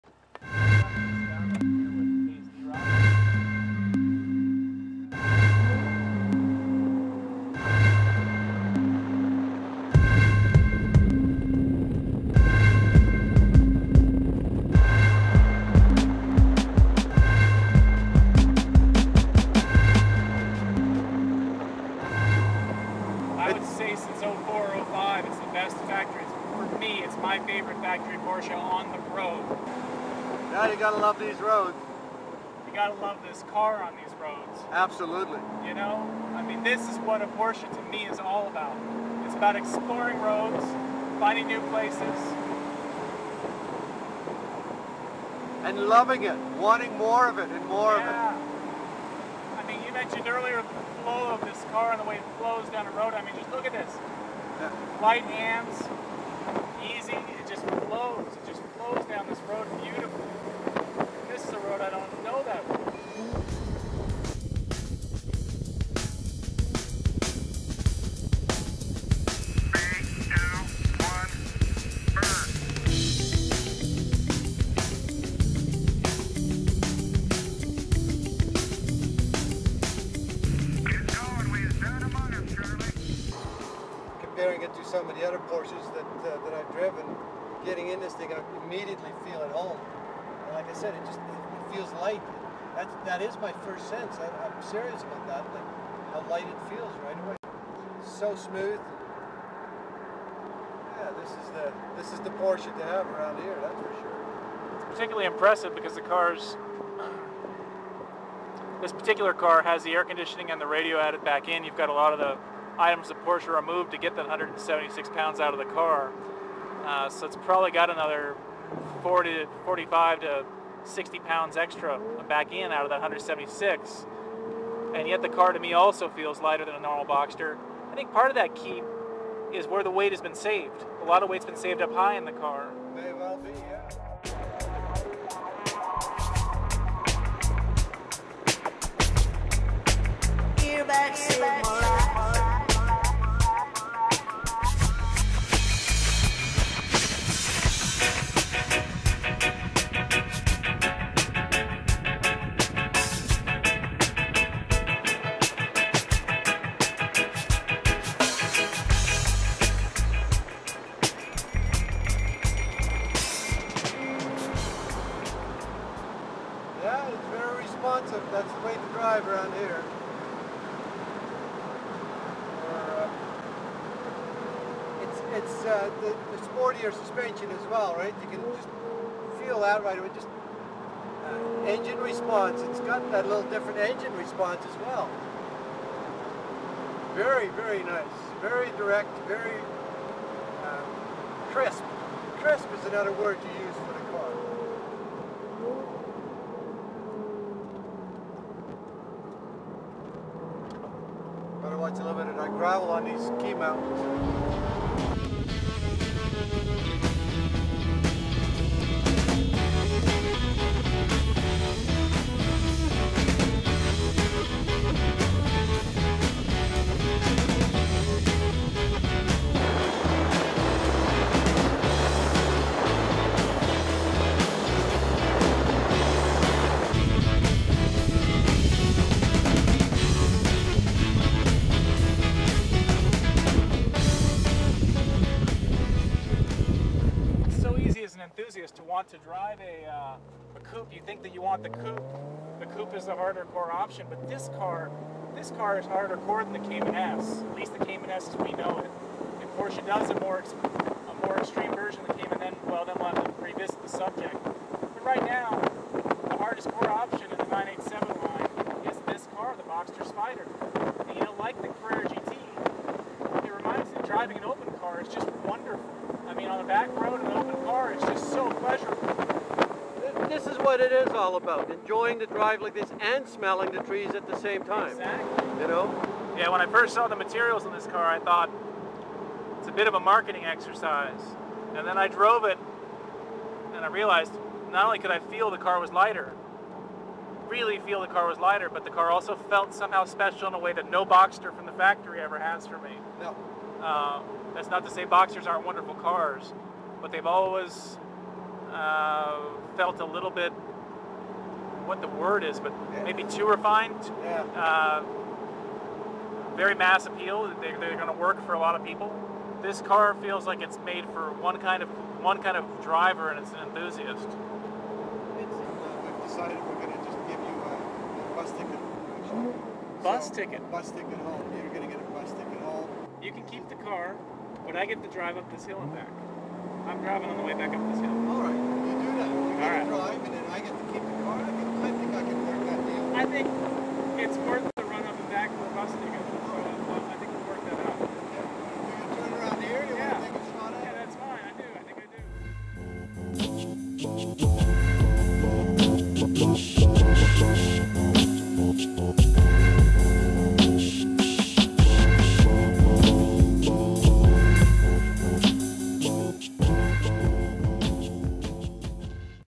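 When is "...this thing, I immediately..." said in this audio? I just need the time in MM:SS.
01:28.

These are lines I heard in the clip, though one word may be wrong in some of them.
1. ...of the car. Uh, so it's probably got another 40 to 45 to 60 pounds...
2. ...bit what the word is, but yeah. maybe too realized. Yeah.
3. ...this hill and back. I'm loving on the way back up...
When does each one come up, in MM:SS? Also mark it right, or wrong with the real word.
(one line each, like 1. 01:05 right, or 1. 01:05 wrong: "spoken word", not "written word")
1. 01:55 right
2. 05:00 wrong: "refined", not "realized"
3. 05:25 wrong: "driving", not "loving".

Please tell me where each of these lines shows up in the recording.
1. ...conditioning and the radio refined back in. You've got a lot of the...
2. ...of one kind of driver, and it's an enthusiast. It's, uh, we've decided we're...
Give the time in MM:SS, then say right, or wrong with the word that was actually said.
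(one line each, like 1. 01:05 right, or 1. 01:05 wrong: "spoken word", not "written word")
1. 01:50 wrong: "added", not "refined"
2. 05:11 right.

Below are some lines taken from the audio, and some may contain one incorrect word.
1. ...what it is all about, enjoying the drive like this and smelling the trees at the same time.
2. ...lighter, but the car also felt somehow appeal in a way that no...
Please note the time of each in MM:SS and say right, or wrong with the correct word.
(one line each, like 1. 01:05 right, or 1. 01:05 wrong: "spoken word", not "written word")
1. 04:30 right
2. 04:48 wrong: "special", not "appeal".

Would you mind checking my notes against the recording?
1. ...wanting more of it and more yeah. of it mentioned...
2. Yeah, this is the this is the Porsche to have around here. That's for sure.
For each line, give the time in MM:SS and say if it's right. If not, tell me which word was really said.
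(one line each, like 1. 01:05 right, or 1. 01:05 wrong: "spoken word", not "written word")
1. 00:46 right
2. 01:40 right.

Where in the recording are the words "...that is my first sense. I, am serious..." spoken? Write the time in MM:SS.
01:33.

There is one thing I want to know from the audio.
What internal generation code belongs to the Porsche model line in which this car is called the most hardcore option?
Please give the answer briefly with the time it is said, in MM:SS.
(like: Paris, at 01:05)
987, at 04:17.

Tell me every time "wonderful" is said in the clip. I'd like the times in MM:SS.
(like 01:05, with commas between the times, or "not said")
04:25, 04:55.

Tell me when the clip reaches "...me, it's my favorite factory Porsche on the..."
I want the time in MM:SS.
00:26.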